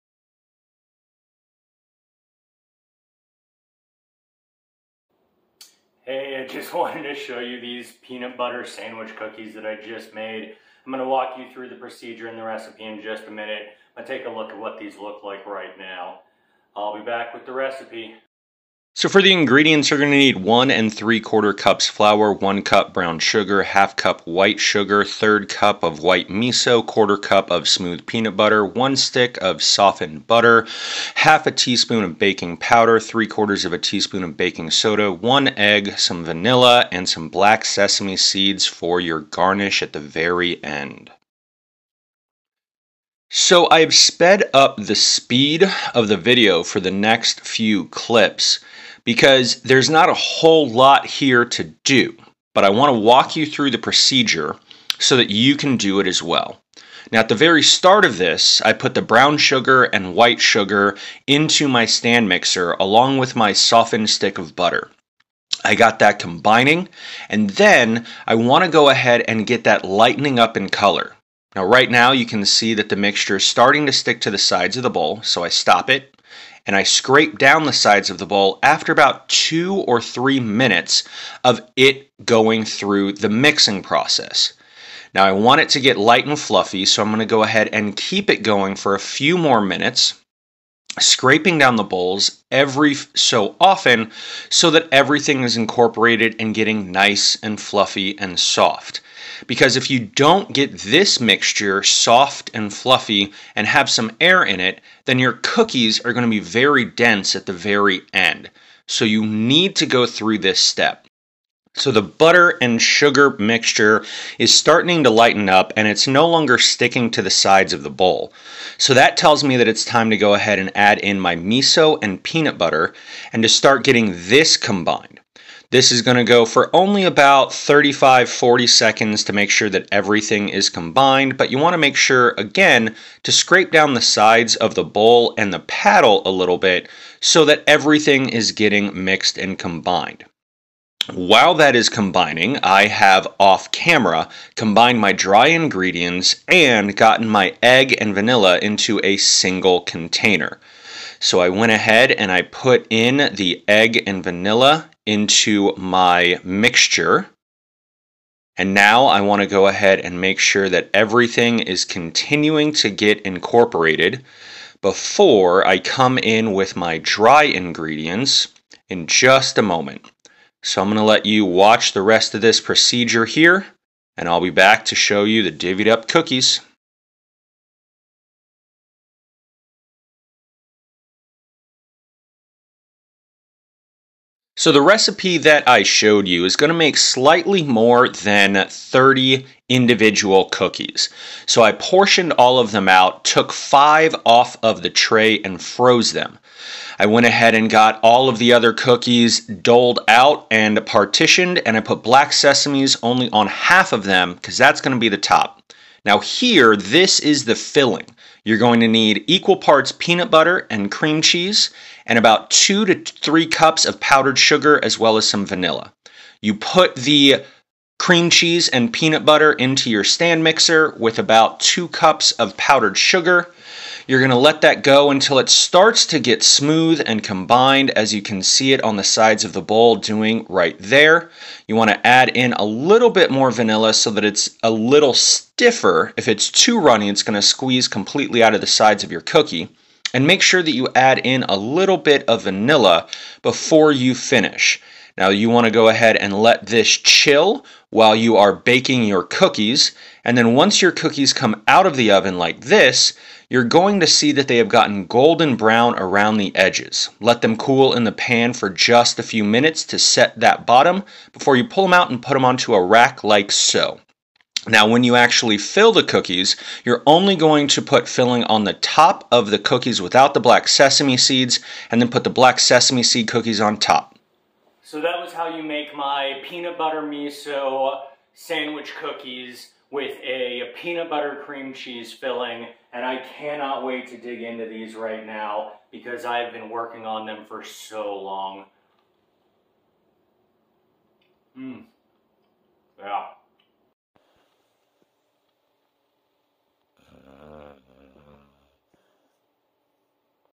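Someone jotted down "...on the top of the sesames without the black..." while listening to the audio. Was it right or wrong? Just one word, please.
wrong.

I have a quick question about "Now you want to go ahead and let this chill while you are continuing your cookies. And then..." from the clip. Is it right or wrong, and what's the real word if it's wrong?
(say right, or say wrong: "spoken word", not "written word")
wrong: "baking", not "continuing".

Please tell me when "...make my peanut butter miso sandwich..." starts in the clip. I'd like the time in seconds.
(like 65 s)
275 s.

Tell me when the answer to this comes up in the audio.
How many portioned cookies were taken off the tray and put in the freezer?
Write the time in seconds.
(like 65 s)
193 s.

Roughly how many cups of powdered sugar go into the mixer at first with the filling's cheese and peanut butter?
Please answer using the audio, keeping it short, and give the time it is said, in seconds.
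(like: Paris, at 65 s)
2 cups, at 221 s.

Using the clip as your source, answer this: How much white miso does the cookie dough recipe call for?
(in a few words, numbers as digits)
1/3 cup.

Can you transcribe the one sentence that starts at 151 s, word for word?
So I went ahead and I put in the egg and vanilla into my mixture.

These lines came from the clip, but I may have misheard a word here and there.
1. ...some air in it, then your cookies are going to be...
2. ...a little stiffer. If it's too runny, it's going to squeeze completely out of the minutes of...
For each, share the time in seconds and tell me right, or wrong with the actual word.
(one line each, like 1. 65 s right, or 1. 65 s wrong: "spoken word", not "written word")
1. 103 s right
2. 234 s wrong: "sides", not "minutes".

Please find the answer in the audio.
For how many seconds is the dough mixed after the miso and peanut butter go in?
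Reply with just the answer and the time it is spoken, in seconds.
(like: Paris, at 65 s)
35-40 seconds, at 127 s.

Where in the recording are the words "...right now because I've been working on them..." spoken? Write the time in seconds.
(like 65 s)
284 s.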